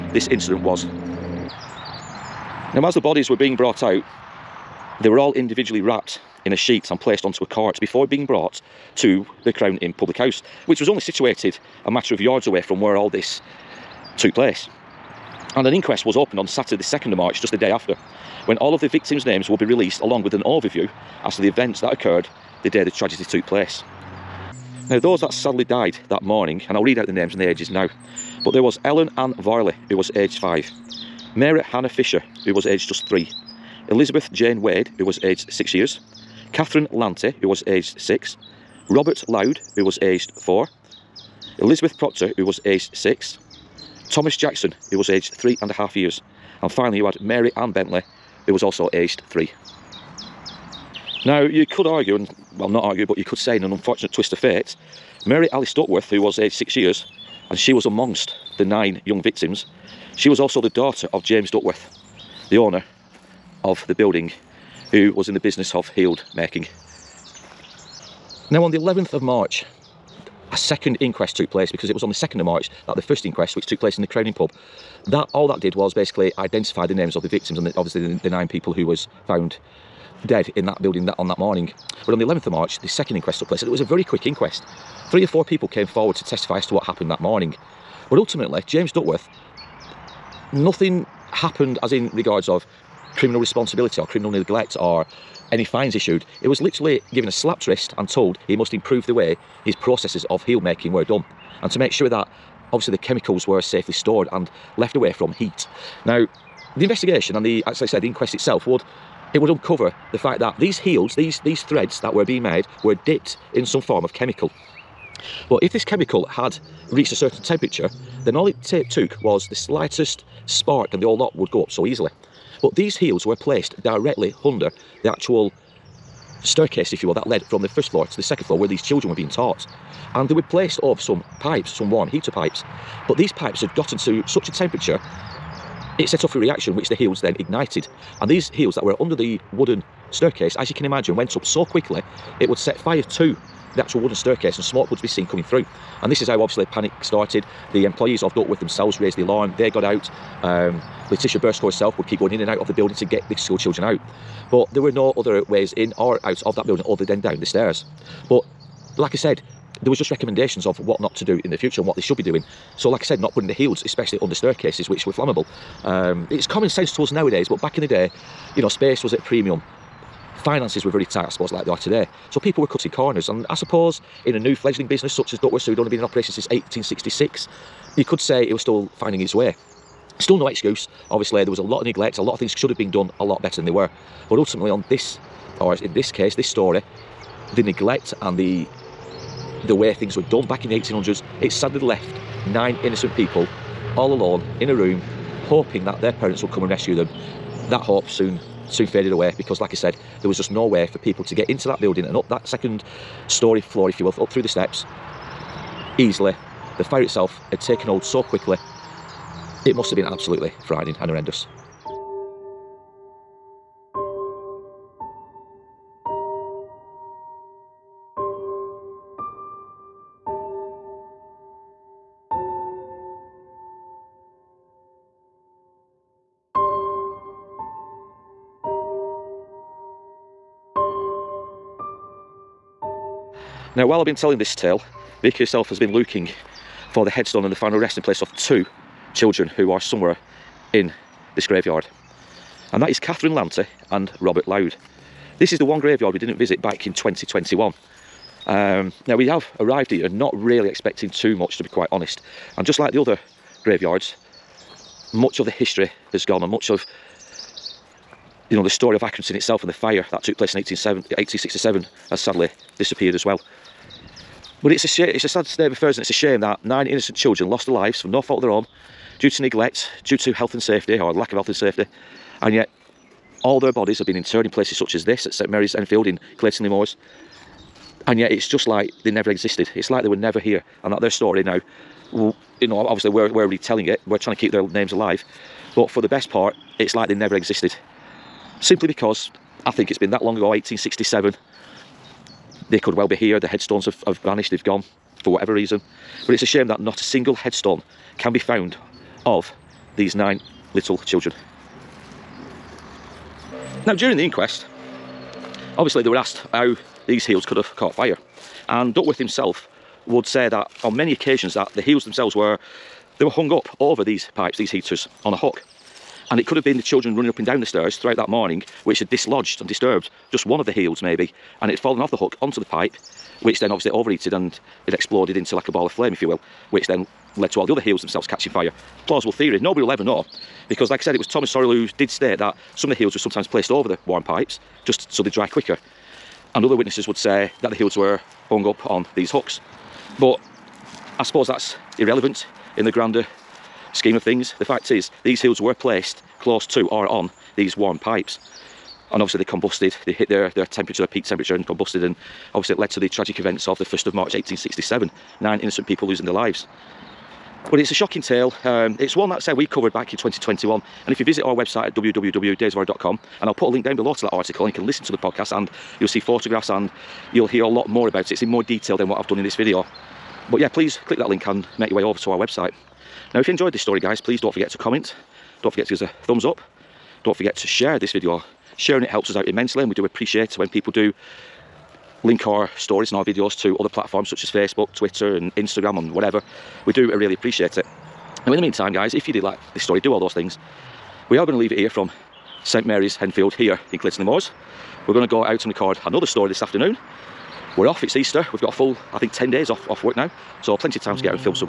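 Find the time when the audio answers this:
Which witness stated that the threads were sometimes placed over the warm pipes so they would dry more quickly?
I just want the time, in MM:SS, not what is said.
05:31.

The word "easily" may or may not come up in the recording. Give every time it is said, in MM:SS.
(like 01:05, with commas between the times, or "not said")
02:01, 03:25.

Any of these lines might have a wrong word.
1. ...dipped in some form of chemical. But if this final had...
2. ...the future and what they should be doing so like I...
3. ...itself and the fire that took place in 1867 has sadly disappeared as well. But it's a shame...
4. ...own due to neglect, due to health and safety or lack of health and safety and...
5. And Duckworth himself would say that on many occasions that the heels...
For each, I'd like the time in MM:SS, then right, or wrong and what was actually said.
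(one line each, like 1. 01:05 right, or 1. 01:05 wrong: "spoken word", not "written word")
1. 01:53 wrong: "chemical", not "final"
2. 02:41 right
3. 04:19 right
4. 04:28 right
5. 05:08 right.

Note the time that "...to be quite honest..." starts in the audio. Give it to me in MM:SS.
04:11.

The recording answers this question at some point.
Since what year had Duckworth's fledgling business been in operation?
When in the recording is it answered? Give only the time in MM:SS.
02:56.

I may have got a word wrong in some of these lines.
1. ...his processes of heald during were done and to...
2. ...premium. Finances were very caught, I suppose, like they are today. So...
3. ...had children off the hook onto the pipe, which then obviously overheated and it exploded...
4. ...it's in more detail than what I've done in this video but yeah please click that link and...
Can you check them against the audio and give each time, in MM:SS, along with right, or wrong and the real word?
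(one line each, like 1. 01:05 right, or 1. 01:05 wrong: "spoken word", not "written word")
1. 01:39 wrong: "making", not "during"
2. 02:49 wrong: "tight", not "caught"
3. 05:21 wrong: "fallen", not "children"
4. 06:08 right.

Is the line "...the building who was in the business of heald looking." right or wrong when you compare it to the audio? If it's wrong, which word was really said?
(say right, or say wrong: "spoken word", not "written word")
wrong: "making", not "looking".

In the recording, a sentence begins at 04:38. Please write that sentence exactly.
And yet it's just like they never existed.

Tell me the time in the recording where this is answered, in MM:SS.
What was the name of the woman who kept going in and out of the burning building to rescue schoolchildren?
02:31.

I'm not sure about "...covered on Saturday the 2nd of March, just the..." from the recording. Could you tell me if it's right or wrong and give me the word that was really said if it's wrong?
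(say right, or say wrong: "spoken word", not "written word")
wrong: "opened", not "covered".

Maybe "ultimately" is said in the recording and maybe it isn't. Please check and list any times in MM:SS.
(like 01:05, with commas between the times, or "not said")
01:28, 03:04.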